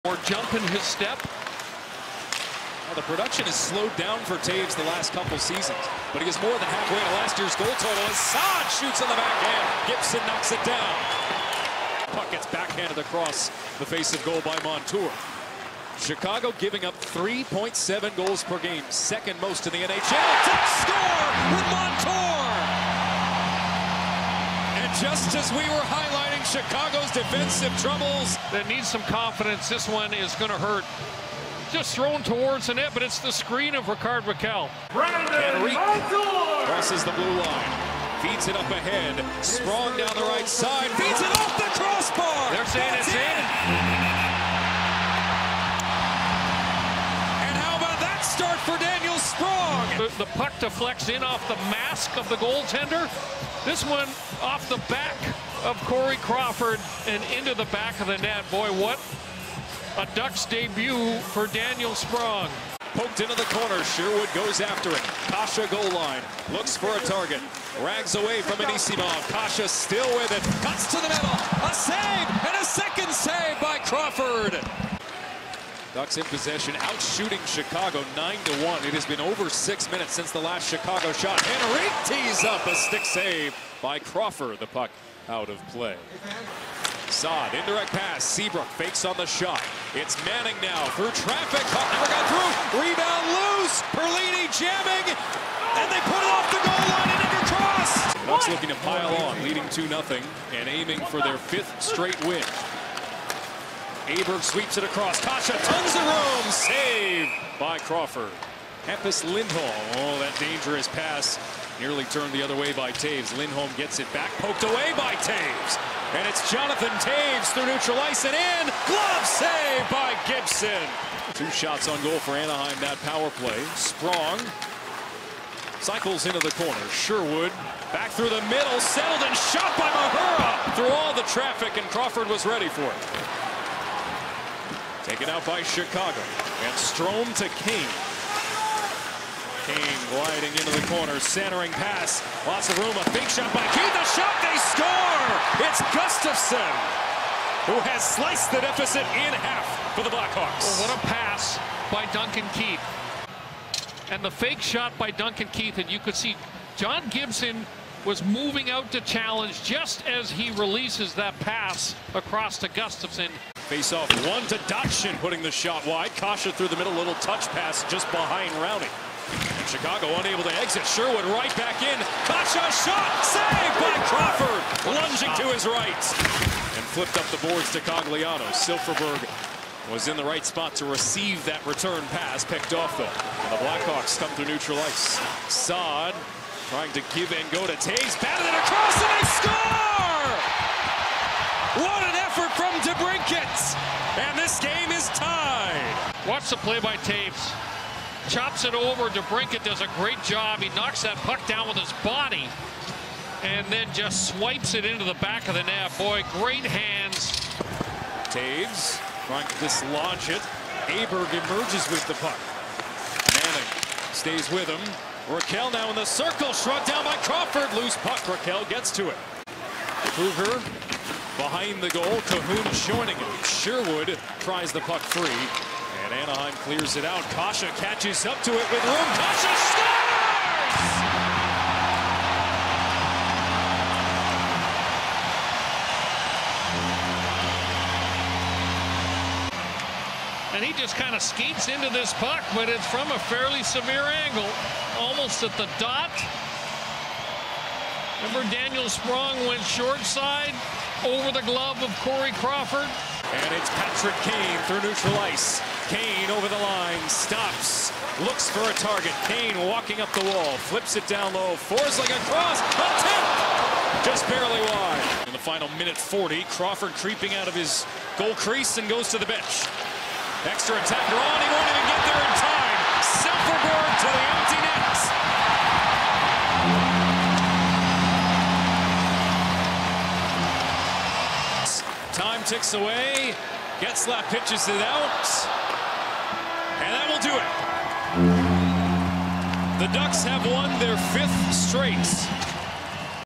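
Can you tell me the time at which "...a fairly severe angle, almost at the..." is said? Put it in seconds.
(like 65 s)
243 s.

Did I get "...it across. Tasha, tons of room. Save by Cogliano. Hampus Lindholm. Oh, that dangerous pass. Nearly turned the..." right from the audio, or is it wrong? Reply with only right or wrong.
wrong.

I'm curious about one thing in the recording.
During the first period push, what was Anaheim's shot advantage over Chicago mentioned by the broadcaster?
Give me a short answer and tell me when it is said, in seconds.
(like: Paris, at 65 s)
9 to 1, at 78 s.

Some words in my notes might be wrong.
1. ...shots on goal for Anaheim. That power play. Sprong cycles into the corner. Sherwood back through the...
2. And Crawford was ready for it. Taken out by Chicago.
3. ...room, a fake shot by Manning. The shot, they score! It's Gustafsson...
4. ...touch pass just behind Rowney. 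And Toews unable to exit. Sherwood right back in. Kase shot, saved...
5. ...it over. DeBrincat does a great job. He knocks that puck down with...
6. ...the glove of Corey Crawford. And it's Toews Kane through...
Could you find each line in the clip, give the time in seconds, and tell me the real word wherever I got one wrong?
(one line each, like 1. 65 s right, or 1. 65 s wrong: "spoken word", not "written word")
1. 121 s right
2. 131 s right
3. 142 s wrong: "Kane", not "Manning"
4. 167 s wrong: "Chicago", not "Toews"
5. 198 s right
6. 251 s wrong: "Patrick", not "Toews".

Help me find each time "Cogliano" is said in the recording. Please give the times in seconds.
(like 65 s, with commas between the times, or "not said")
177 s.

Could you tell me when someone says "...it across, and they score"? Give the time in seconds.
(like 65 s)
188 s.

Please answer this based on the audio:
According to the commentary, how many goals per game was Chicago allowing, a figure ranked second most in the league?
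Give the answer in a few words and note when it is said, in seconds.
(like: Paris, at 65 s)
3.7, at 17 s.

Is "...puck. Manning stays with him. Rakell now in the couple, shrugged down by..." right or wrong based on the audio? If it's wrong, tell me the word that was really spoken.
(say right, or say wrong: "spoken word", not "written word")
wrong: "circle", not "couple".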